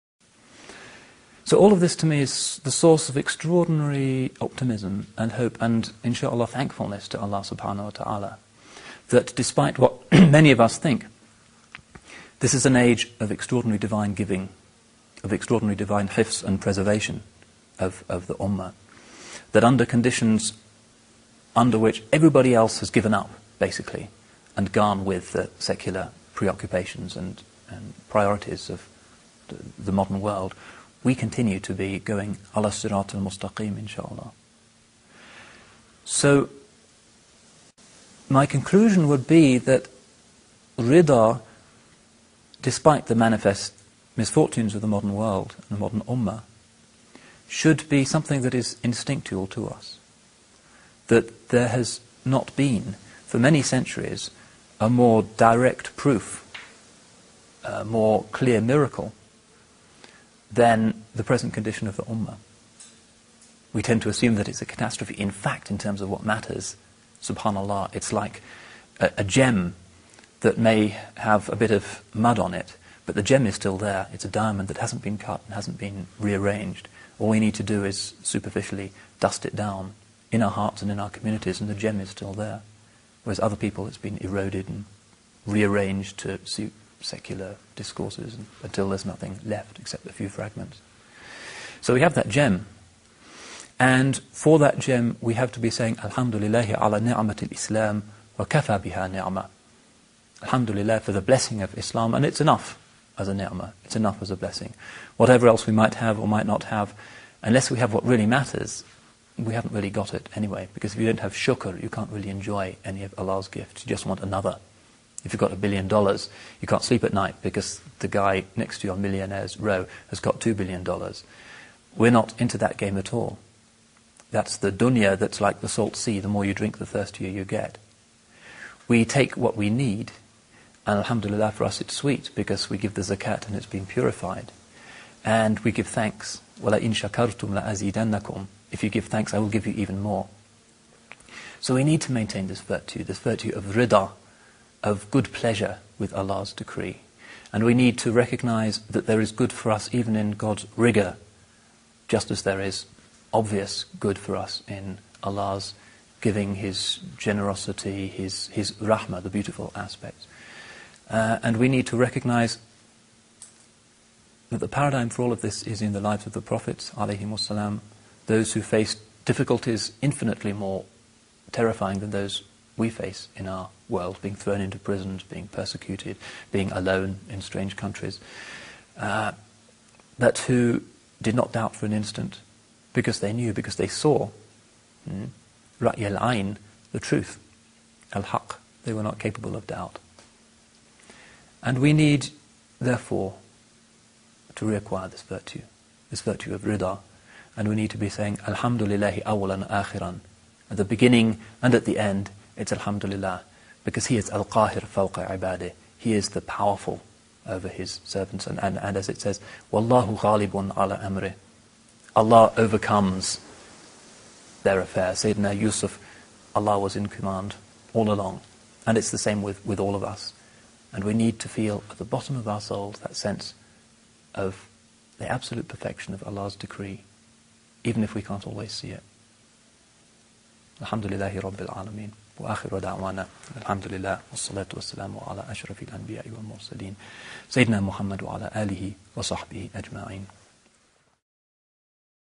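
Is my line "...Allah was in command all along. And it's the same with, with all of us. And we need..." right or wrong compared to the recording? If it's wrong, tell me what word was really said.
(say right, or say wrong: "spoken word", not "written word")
right.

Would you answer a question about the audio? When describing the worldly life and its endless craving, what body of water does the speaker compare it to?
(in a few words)
The salt sea.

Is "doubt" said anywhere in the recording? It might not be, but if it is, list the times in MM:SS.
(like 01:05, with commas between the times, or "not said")
03:01, 03:09.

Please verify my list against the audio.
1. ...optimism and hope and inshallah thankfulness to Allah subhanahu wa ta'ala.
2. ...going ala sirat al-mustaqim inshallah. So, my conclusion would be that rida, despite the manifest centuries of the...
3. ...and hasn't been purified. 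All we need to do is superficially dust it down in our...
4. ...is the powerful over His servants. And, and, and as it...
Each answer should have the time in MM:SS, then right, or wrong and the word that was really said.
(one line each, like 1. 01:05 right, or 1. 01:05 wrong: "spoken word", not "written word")
1. 00:04 right
2. 00:31 wrong: "misfortunes", not "centuries"
3. 01:15 wrong: "rearranged", not "purified"
4. 03:26 right.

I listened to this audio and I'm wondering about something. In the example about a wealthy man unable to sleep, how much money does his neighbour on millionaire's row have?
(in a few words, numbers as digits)
2 billion dollars.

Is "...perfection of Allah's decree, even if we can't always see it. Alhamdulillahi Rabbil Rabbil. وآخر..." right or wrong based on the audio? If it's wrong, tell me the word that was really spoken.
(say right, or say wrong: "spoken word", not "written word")
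wrong: "Alameen", not "Rabbil".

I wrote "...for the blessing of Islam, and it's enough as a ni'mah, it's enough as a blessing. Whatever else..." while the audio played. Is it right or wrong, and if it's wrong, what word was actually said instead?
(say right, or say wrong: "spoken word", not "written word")
right.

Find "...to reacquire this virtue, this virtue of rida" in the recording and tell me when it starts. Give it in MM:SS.
03:14.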